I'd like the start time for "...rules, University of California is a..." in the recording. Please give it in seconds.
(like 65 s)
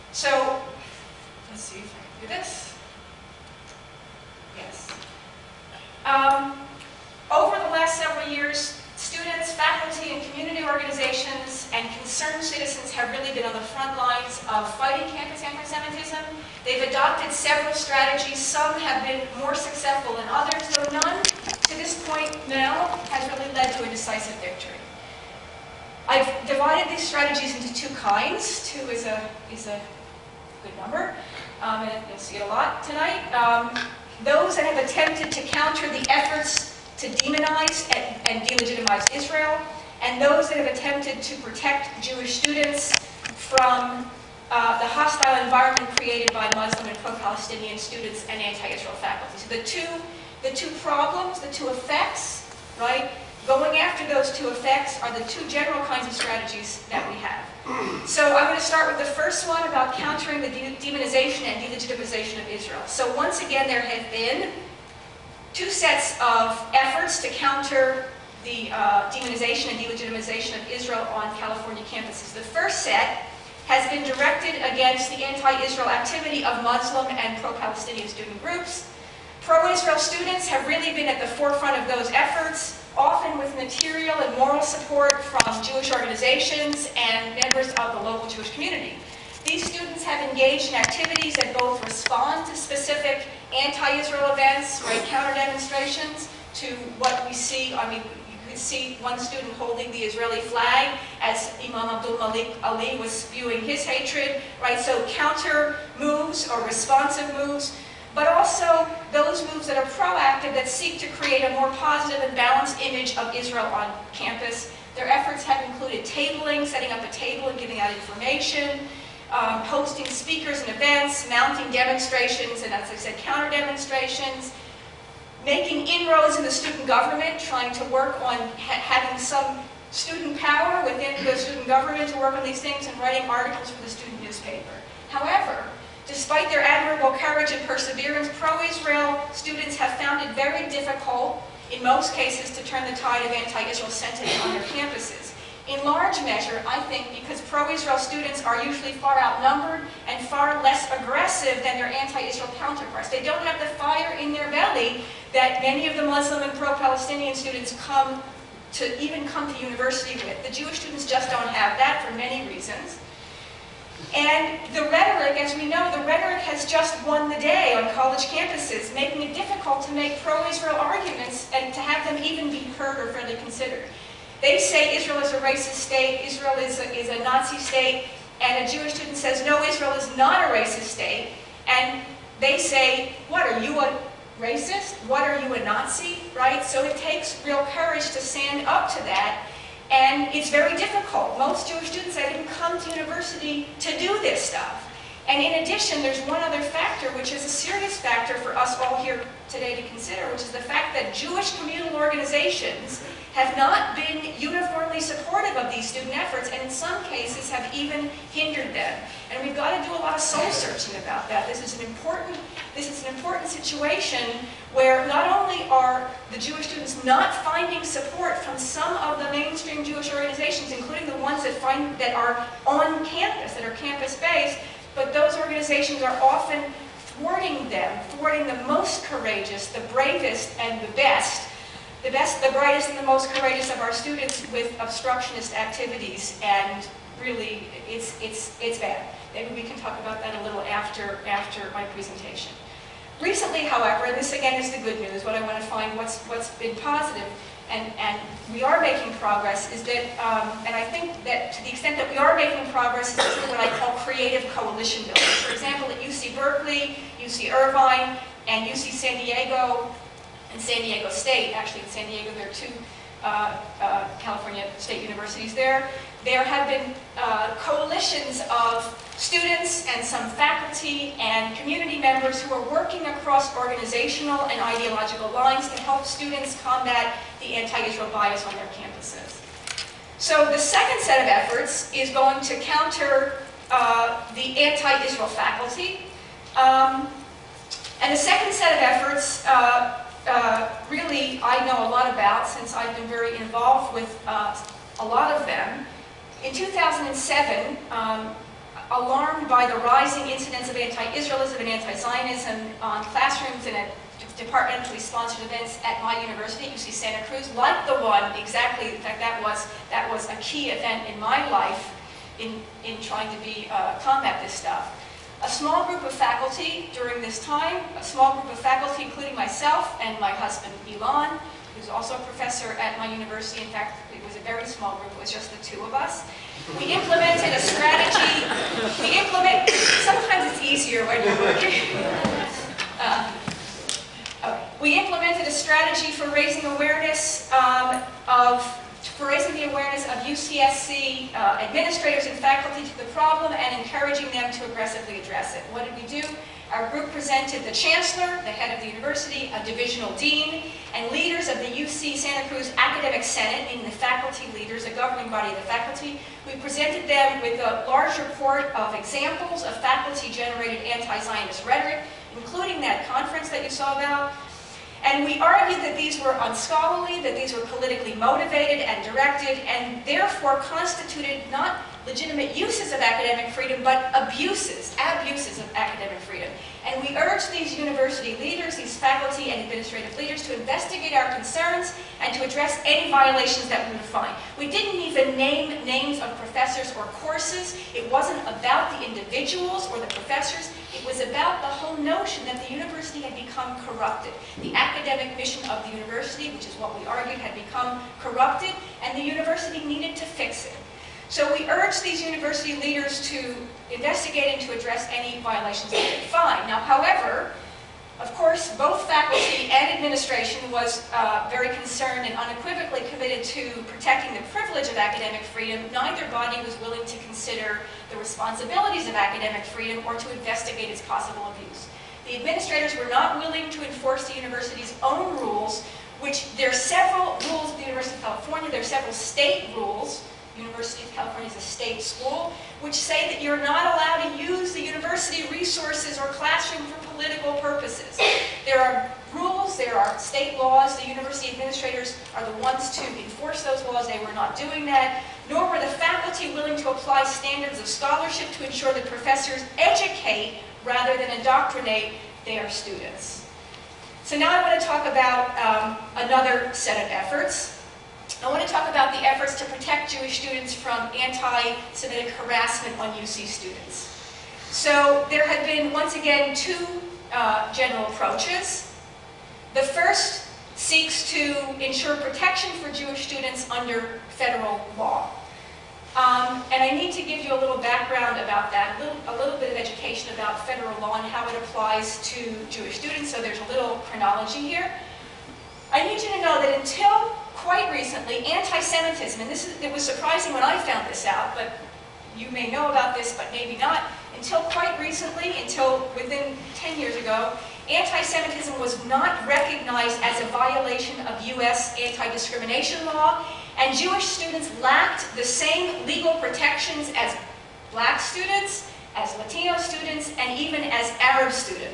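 429 s.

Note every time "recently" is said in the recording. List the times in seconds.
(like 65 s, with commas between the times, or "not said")
243 s, 487 s, 495 s.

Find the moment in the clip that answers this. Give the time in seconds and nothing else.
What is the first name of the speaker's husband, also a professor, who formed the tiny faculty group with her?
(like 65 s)
320 s.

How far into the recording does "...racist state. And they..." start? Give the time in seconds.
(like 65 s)
180 s.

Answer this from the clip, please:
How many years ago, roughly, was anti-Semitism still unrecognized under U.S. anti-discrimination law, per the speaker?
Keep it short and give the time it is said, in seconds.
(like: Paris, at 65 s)
10 years, at 496 s.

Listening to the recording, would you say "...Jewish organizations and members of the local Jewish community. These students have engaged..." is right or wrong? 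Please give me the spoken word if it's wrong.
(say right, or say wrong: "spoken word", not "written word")
right.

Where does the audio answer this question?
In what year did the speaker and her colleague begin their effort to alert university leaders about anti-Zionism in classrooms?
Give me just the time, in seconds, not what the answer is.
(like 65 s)
296 s.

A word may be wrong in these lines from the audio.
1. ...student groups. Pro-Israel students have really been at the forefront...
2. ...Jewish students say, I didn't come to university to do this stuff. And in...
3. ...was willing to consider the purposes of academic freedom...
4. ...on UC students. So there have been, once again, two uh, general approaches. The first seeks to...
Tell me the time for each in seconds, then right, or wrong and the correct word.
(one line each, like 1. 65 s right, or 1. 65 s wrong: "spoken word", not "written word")
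1. 78 s right
2. 191 s right
3. 416 s wrong: "responsibilities", not "purposes"
4. 462 s right.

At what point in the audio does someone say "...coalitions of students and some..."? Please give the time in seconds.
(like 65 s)
267 s.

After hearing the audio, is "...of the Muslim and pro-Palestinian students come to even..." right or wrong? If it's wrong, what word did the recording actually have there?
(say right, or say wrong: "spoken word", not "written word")
right.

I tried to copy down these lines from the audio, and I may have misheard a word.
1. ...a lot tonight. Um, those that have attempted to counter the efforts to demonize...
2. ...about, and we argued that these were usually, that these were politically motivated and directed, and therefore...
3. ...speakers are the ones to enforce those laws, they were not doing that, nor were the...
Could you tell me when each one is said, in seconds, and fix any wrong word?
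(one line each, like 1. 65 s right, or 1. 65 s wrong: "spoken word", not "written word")
1. 32 s right
2. 363 s wrong: "unscholarly", not "usually"
3. 441 s wrong: "administrators", not "speakers".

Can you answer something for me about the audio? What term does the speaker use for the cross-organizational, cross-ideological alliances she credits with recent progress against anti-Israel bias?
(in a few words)
creative coalition building.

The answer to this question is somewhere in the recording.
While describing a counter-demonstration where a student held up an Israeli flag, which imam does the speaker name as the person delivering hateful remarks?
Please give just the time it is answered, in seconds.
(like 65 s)
101 s.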